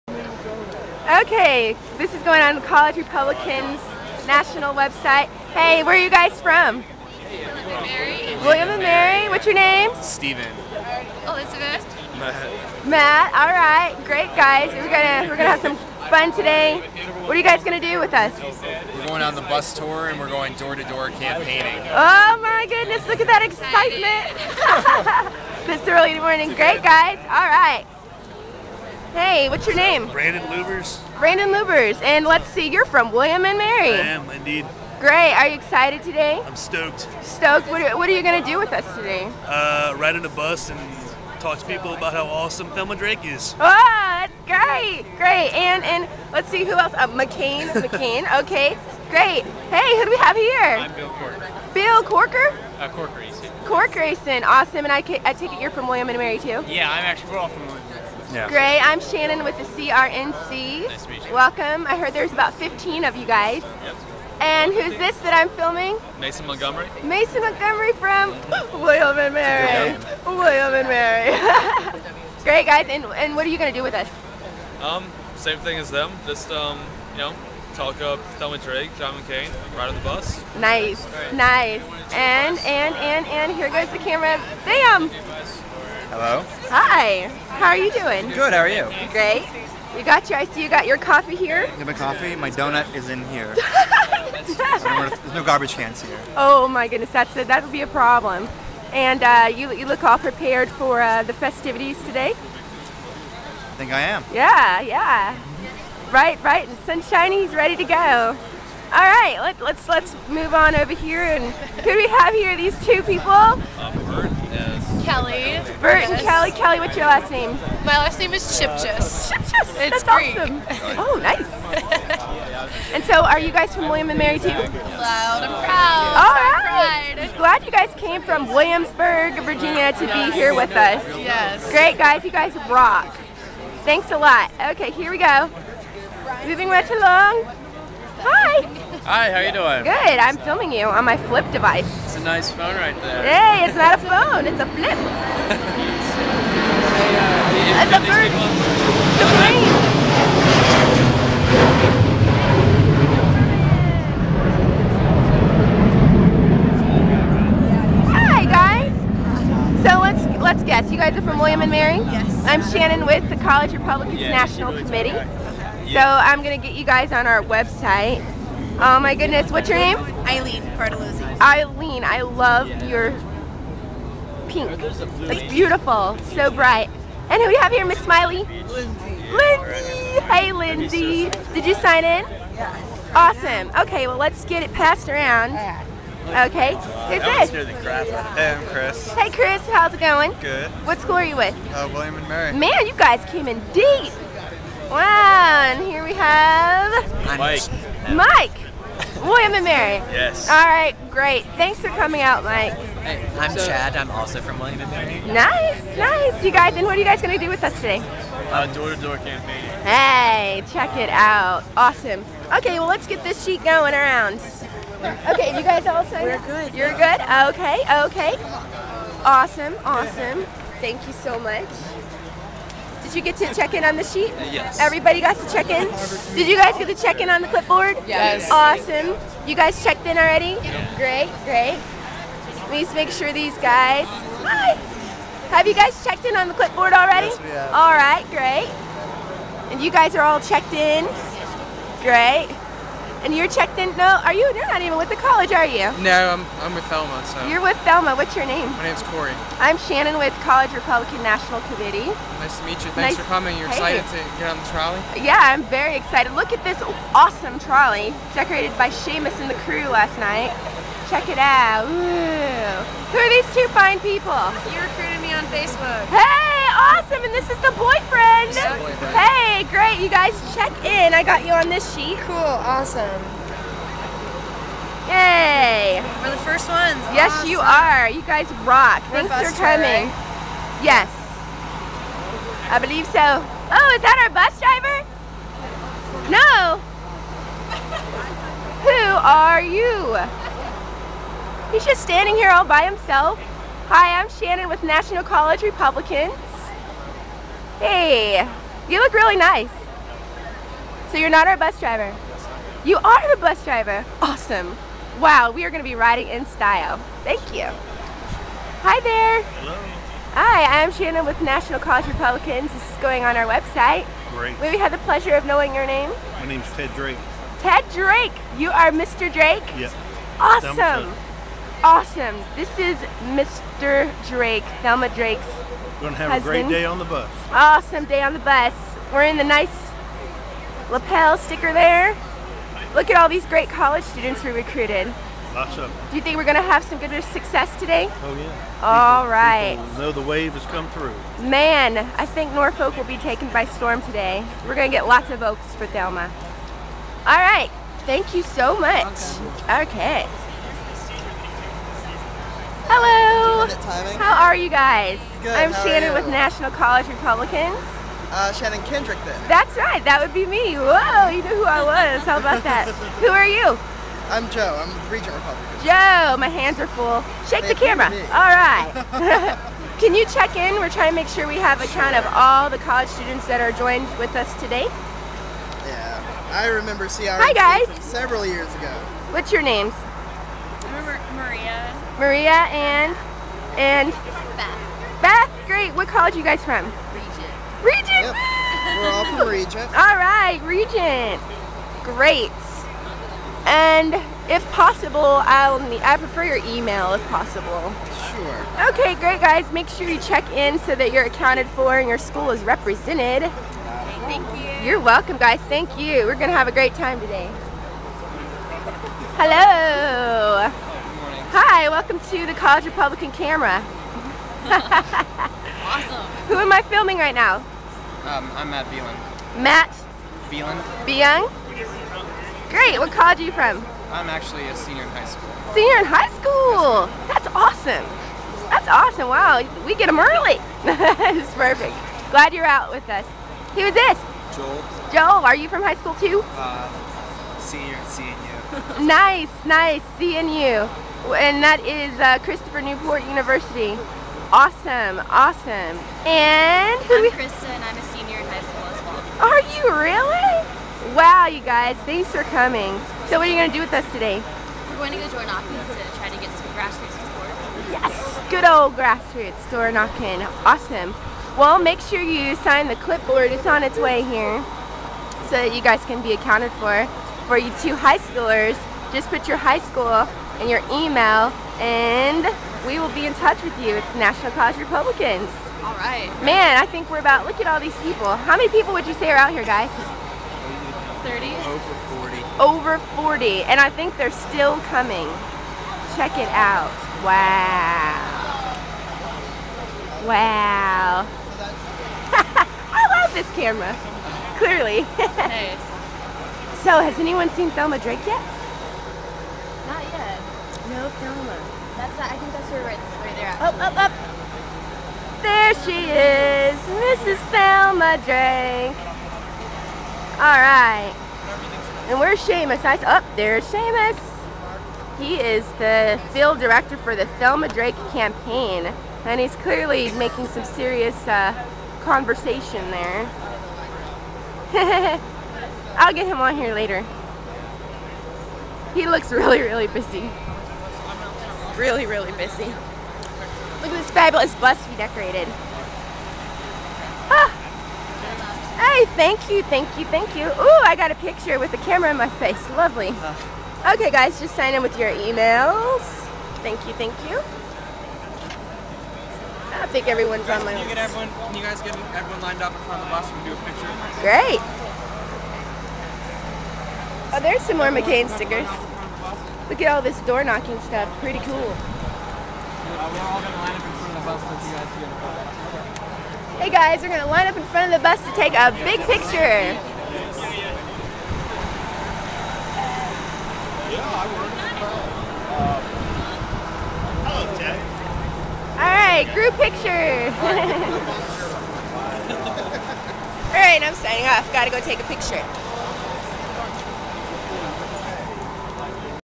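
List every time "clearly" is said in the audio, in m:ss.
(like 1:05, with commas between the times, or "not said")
8:14, 8:39.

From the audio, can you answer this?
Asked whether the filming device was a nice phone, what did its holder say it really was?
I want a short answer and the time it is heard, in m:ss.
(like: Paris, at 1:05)
a flip, at 2:24.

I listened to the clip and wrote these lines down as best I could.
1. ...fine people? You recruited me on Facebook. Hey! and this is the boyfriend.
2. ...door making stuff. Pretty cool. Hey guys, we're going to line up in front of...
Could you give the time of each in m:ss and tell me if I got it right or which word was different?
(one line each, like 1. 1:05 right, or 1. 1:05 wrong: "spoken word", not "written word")
1. 4:23 right
2. 9:20 wrong: "knocking", not "making".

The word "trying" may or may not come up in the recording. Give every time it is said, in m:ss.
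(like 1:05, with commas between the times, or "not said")
6:10.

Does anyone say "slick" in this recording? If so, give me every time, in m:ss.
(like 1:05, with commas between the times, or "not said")
not said.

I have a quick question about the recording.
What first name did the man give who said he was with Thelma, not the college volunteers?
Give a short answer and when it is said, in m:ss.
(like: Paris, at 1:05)
Corey, at 4:08.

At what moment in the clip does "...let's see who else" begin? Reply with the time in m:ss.
0:46.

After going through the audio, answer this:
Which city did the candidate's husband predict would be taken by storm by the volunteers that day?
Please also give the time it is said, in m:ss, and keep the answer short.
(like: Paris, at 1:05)
Norfolk, at 5:42.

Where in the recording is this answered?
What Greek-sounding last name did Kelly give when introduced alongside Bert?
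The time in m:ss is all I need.
1:57.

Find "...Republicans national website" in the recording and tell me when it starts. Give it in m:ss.
0:02.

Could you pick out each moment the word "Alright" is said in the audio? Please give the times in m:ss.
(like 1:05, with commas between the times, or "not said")
9:38, 9:43.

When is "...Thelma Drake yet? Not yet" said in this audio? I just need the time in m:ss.
8:17.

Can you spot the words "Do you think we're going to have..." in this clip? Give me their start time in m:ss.
5:36.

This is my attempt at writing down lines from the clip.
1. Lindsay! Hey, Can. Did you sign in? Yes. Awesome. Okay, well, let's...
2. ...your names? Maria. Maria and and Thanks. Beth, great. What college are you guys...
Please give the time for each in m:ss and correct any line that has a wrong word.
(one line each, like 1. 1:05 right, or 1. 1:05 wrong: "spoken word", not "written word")
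1. 2:59 wrong: "Lindsay", not "Can"
2. 6:19 wrong: "Beth", not "Thanks".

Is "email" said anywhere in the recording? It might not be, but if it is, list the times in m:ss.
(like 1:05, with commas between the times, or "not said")
6:36, 7:50, 9:05.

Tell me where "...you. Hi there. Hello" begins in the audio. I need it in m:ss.
5:07.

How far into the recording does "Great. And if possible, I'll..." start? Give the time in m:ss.
6:32.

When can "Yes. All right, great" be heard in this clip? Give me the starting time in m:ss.
3:20.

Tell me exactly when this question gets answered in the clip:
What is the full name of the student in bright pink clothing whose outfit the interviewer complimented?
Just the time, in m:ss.
2:50.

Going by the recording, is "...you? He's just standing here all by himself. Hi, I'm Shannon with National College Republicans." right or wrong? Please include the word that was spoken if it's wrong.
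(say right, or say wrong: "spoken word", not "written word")
right.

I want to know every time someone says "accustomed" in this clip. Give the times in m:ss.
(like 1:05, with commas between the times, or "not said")
not said.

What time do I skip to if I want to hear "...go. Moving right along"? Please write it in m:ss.
2:15.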